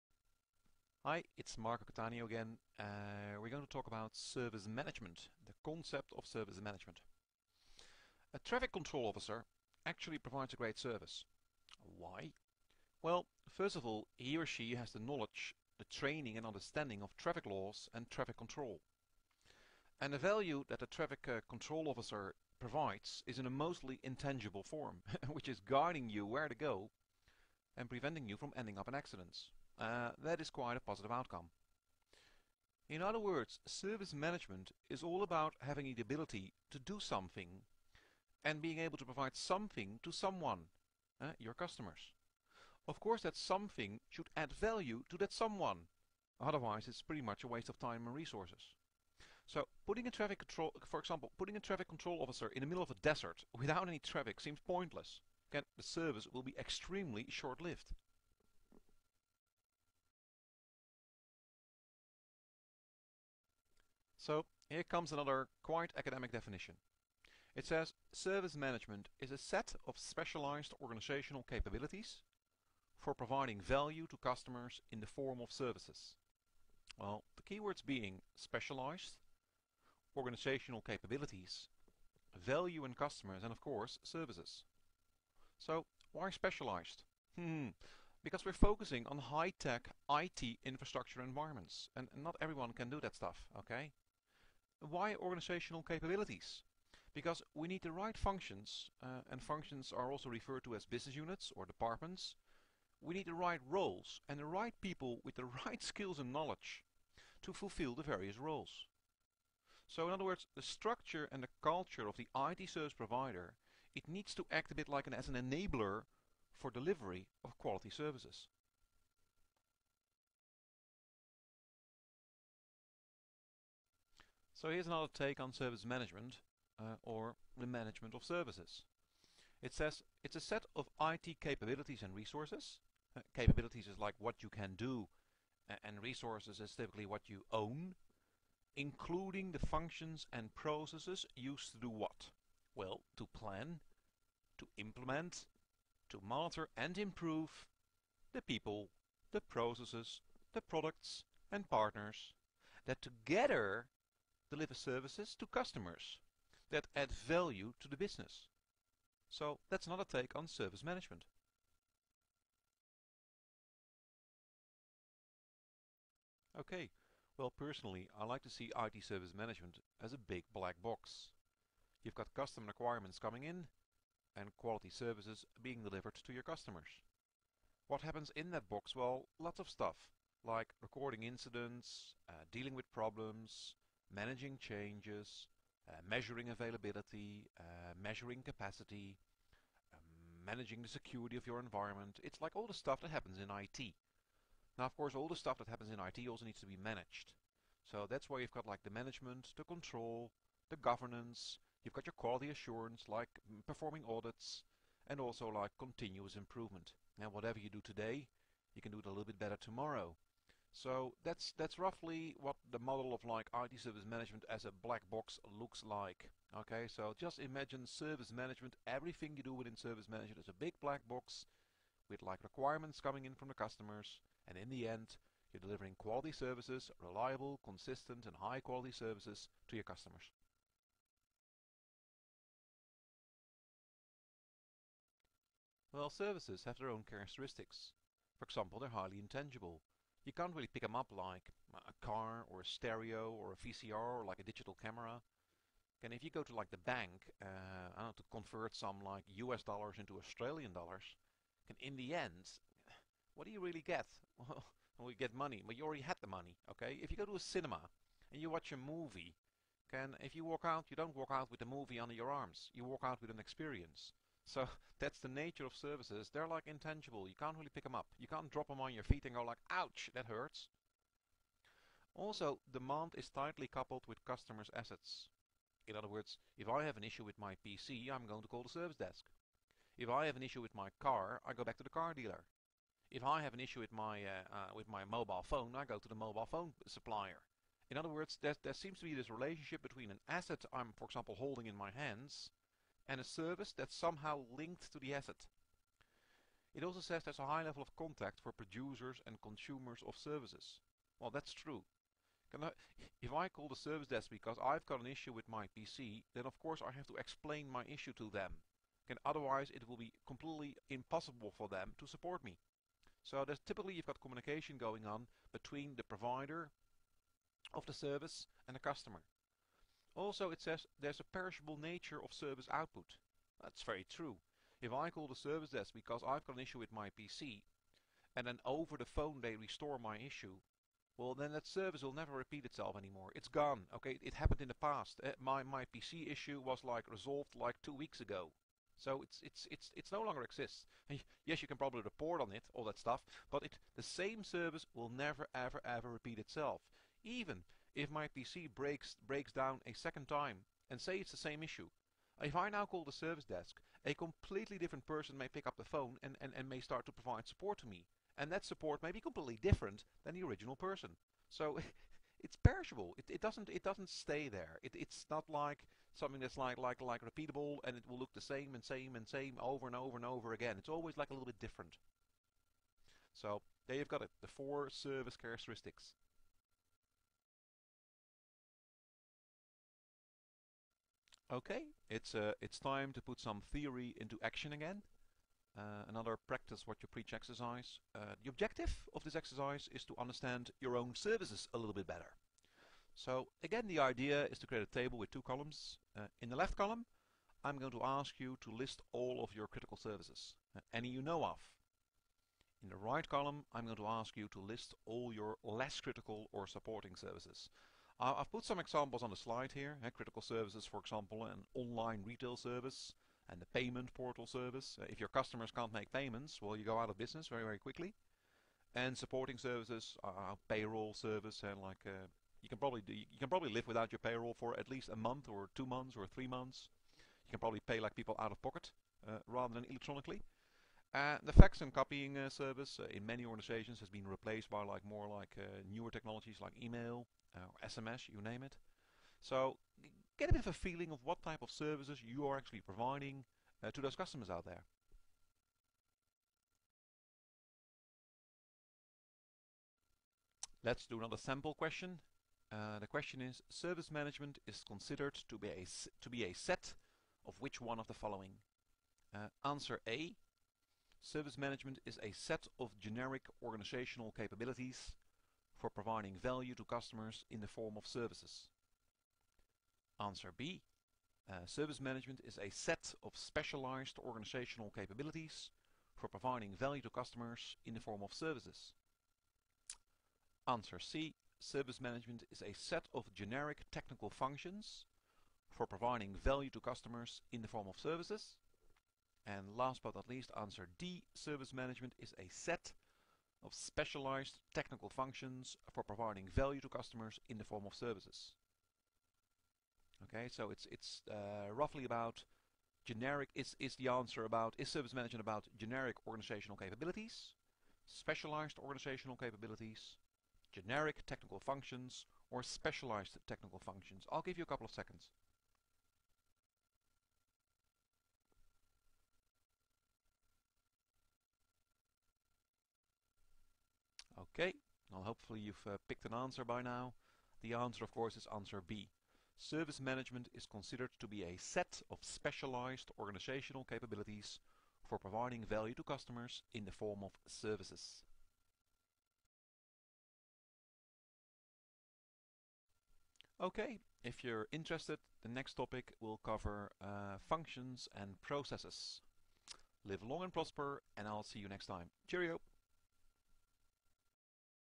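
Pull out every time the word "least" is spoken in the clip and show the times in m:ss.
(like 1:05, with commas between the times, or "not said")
7:04, 8:10.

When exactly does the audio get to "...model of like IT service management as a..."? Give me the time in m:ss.
3:32.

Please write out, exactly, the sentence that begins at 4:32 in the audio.
Also, demand is tightly coupled with customers' assets.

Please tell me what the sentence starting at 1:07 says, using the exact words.
It says service management is a set of specialized organizational capabilities for providing value to customers in the form of services.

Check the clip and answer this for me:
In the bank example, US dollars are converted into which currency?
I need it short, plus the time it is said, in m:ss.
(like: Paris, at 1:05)
Australian dollars, at 4:10.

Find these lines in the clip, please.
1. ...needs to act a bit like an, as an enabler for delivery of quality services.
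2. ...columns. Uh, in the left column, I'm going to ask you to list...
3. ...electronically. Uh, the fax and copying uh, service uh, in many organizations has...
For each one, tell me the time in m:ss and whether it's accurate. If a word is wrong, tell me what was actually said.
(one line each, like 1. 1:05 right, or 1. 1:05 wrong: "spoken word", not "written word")
1. 1:54 right
2. 6:35 right
3. 7:09 right.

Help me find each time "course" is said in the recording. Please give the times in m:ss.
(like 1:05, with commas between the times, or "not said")
0:42, 1:23, 3:14, 5:06, 8:48.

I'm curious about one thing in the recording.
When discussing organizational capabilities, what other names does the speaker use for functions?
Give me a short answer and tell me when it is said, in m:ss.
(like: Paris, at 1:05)
business units or departments, at 1:40.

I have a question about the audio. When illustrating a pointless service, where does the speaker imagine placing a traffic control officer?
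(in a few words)
in the middle of a desert.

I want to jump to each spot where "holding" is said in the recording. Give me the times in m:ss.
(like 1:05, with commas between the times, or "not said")
4:51.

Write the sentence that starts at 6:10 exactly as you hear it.
It's always like a little bit different.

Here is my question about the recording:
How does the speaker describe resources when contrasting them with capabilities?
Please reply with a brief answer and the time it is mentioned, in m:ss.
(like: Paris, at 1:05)
what you own, at 2:17.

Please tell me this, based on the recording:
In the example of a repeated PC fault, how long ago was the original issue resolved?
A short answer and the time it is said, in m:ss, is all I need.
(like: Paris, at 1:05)
two weeks ago, at 5:37.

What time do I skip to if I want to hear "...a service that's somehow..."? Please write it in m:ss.
4:53.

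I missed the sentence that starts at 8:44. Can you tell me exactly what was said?
Okay, well hopefully you've uh, picked an answer by now.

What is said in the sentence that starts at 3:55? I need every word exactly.
Well, services have their own characteristics.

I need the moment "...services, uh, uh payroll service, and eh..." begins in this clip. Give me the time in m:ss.
6:59.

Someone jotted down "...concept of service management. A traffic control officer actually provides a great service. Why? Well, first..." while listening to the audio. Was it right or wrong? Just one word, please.
right.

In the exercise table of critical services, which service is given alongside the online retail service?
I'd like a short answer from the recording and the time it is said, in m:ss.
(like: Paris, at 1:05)
payment portal service, at 6:53.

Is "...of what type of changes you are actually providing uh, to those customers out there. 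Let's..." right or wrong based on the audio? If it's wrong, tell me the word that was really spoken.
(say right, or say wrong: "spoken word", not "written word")
wrong: "services", not "changes".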